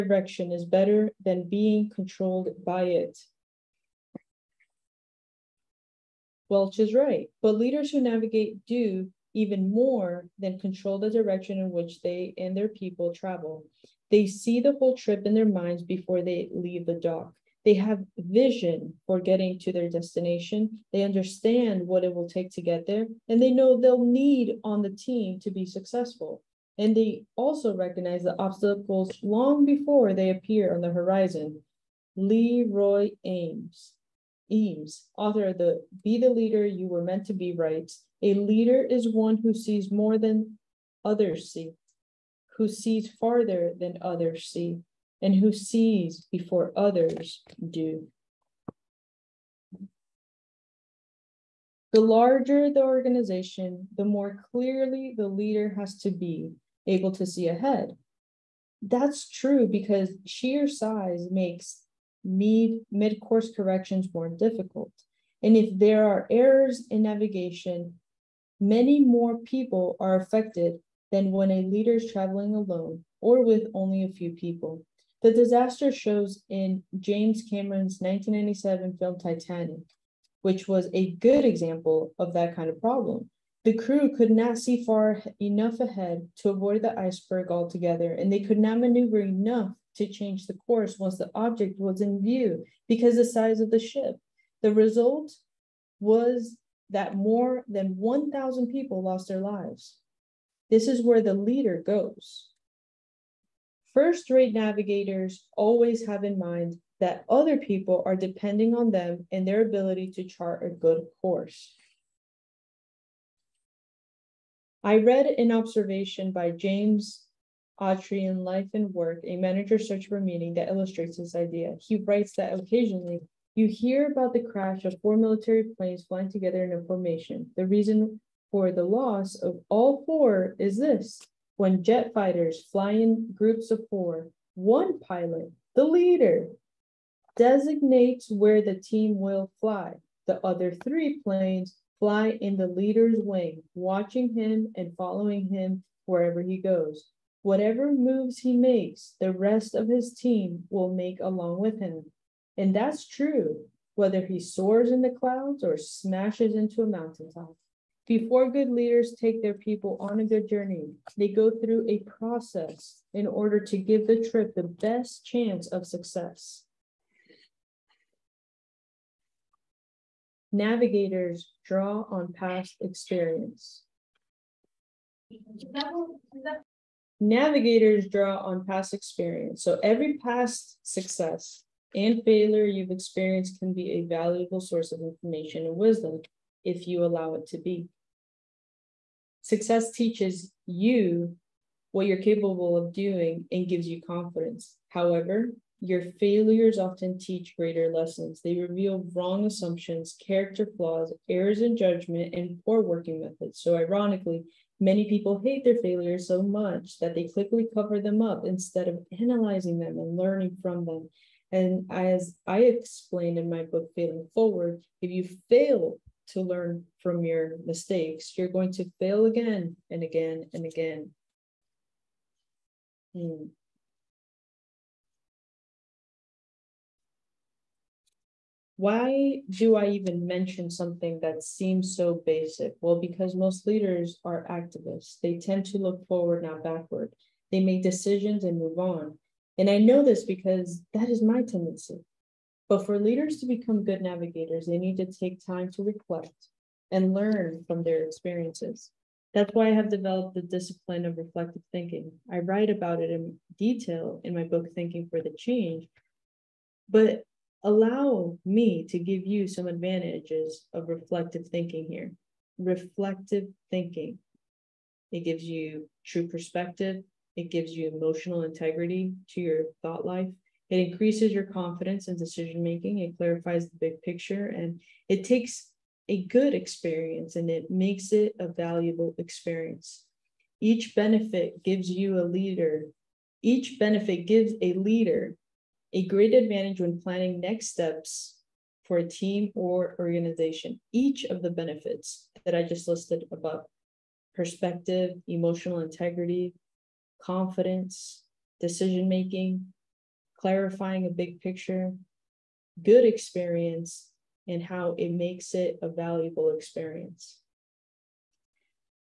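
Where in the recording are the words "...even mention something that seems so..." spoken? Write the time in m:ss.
3:49.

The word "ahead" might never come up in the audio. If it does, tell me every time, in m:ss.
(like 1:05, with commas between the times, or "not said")
0:57, 1:25.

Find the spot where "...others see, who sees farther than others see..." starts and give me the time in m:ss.
0:41.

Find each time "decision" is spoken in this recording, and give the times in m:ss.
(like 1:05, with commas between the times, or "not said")
3:57, 4:32, 4:58.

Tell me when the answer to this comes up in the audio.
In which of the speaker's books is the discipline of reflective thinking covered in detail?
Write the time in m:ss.
4:14.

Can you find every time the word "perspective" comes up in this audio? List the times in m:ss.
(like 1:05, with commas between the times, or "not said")
4:26, 4:54.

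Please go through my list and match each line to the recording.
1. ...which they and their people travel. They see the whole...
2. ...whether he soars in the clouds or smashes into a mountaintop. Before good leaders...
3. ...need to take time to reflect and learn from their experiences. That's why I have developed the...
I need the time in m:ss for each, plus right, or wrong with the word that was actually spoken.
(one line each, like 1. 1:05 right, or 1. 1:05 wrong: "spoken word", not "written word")
1. 0:11 right
2. 2:33 right
3. 4:04 right.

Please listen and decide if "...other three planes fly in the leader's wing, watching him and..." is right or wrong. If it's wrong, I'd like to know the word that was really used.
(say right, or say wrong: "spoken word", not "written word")
right.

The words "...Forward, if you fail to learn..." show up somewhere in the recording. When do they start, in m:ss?
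3:34.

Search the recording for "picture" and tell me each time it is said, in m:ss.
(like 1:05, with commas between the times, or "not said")
4:34, 5:01.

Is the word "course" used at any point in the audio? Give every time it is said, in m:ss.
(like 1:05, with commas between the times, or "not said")
1:03, 1:30, 1:51.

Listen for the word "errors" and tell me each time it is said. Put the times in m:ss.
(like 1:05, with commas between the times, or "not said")
1:06, 3:21.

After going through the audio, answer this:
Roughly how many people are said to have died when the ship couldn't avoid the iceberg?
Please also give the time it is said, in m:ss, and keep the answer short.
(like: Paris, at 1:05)
1,000, at 1:37.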